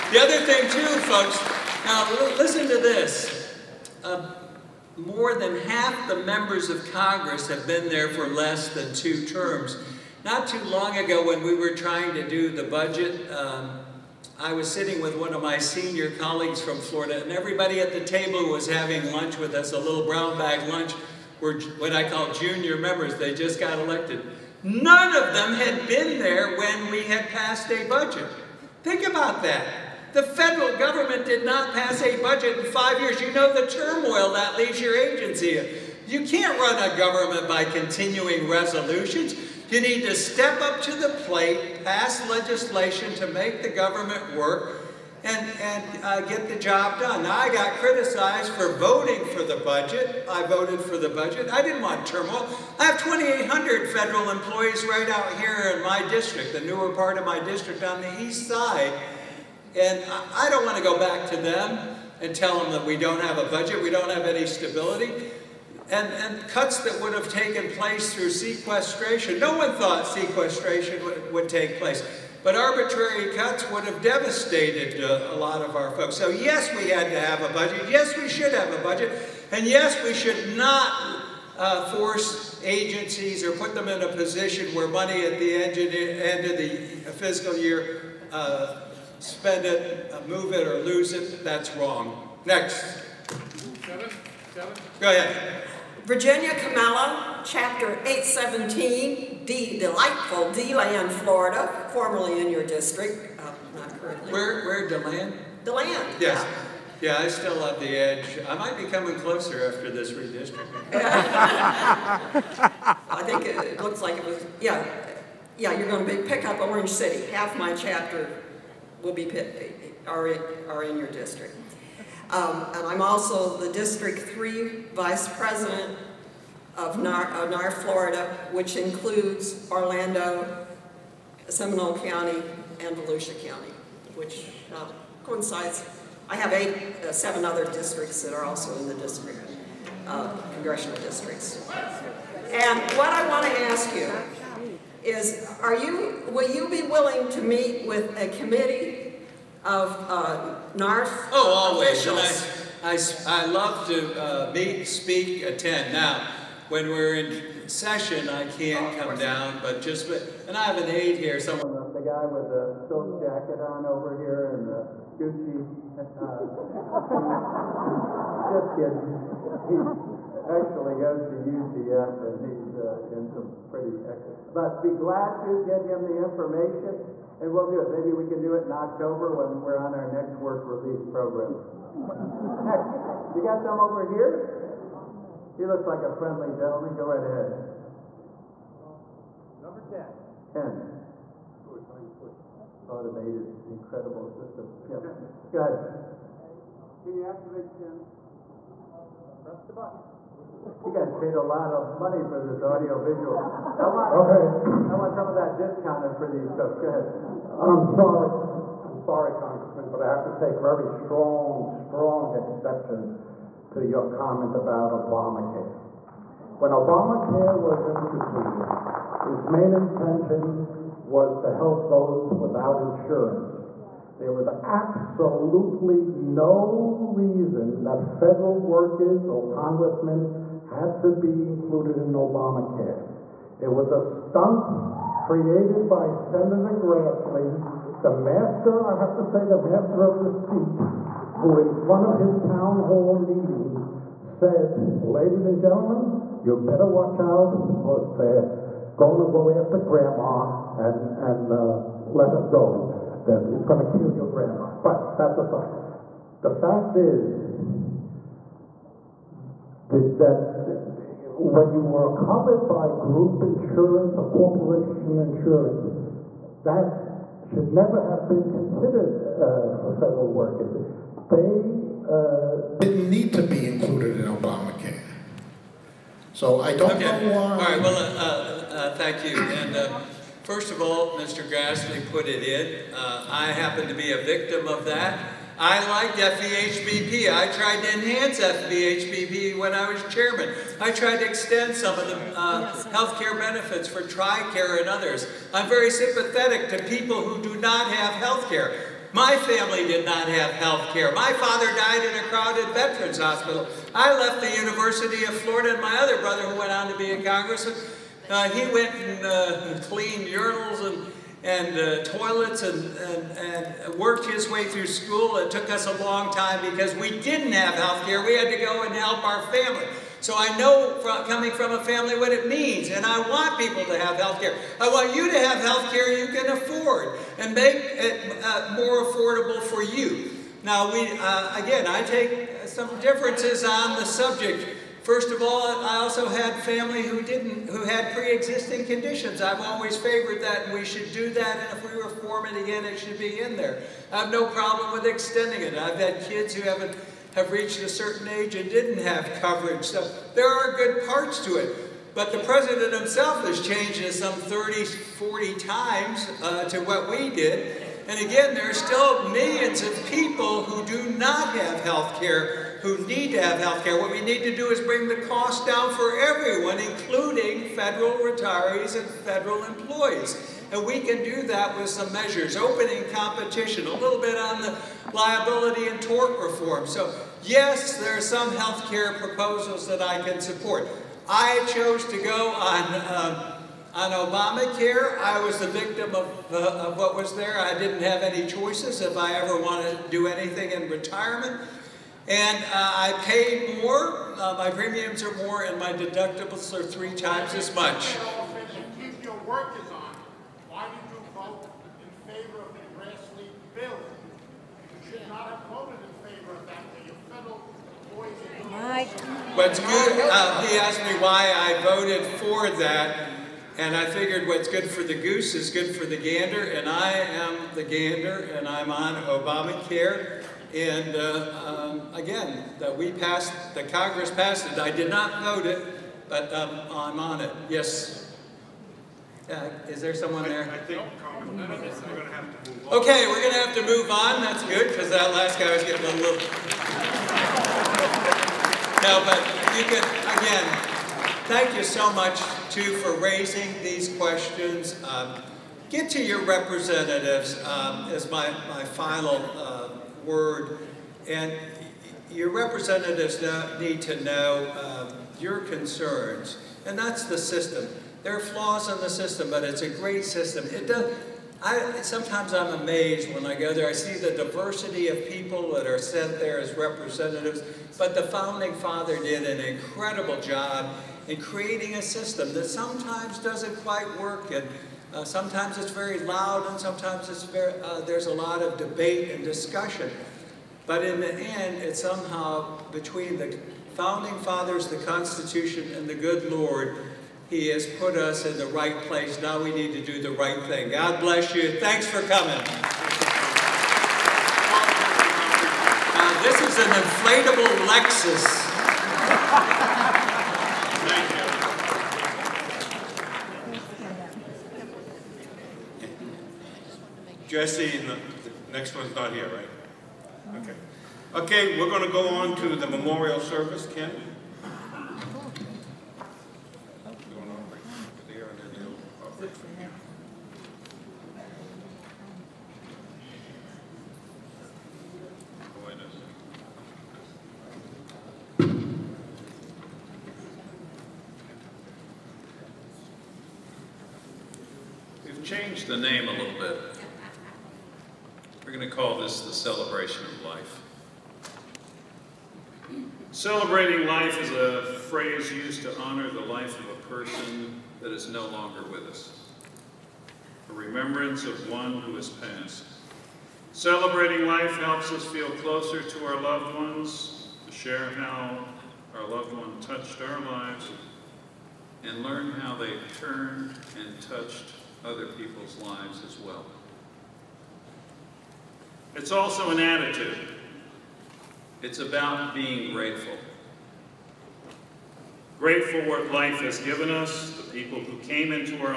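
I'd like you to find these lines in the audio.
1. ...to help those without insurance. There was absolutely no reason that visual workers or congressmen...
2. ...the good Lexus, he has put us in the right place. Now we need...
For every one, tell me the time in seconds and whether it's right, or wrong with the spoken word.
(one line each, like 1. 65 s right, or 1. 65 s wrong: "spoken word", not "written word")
1. 221 s wrong: "federal", not "visual"
2. 486 s wrong: "Lord", not "Lexus".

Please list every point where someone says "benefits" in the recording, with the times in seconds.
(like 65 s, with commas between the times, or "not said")
293 s.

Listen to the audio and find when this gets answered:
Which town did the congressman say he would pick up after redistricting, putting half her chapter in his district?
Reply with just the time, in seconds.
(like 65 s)
116 s.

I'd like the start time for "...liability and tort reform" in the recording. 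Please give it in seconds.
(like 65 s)
375 s.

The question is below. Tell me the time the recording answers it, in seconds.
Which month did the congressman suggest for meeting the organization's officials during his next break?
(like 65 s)
178 s.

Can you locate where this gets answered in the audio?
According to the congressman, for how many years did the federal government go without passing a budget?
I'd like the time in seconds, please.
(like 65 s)
32 s.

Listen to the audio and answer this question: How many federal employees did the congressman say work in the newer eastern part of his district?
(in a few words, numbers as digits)
2,800.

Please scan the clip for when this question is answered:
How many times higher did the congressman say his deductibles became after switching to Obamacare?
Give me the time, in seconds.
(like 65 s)
396 s.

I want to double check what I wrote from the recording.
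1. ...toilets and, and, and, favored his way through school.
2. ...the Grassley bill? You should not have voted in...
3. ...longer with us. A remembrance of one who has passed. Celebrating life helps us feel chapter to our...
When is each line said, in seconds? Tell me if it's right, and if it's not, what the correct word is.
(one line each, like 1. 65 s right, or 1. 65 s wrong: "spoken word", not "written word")
1. 312 s wrong: "worked", not "favored"
2. 402 s right
3. 548 s wrong: "closer", not "chapter".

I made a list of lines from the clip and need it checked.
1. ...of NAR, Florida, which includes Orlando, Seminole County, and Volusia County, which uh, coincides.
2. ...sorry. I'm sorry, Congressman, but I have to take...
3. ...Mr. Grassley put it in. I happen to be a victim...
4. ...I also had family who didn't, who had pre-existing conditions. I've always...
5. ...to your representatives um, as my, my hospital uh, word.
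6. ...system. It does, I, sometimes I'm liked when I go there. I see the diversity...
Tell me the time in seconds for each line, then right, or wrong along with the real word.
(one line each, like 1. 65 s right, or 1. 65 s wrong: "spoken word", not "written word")
1. 127 s right
2. 207 s right
3. 281 s right
4. 335 s right
5. 446 s wrong: "final", not "hospital"
6. 460 s wrong: "amazed", not "liked".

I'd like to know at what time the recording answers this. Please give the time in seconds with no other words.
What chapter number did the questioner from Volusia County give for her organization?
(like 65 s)
97 s.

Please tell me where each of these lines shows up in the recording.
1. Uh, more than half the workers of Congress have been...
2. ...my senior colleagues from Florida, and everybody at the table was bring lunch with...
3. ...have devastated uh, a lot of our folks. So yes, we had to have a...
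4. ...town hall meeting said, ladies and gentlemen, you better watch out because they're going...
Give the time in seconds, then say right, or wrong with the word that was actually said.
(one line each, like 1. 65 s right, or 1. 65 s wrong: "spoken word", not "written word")
1. 4 s wrong: "members", not "workers"
2. 15 s wrong: "having", not "bring"
3. 73 s right
4. 242 s right.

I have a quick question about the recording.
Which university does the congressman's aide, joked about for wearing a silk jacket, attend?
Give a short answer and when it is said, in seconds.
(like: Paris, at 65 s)
UCF, at 171 s.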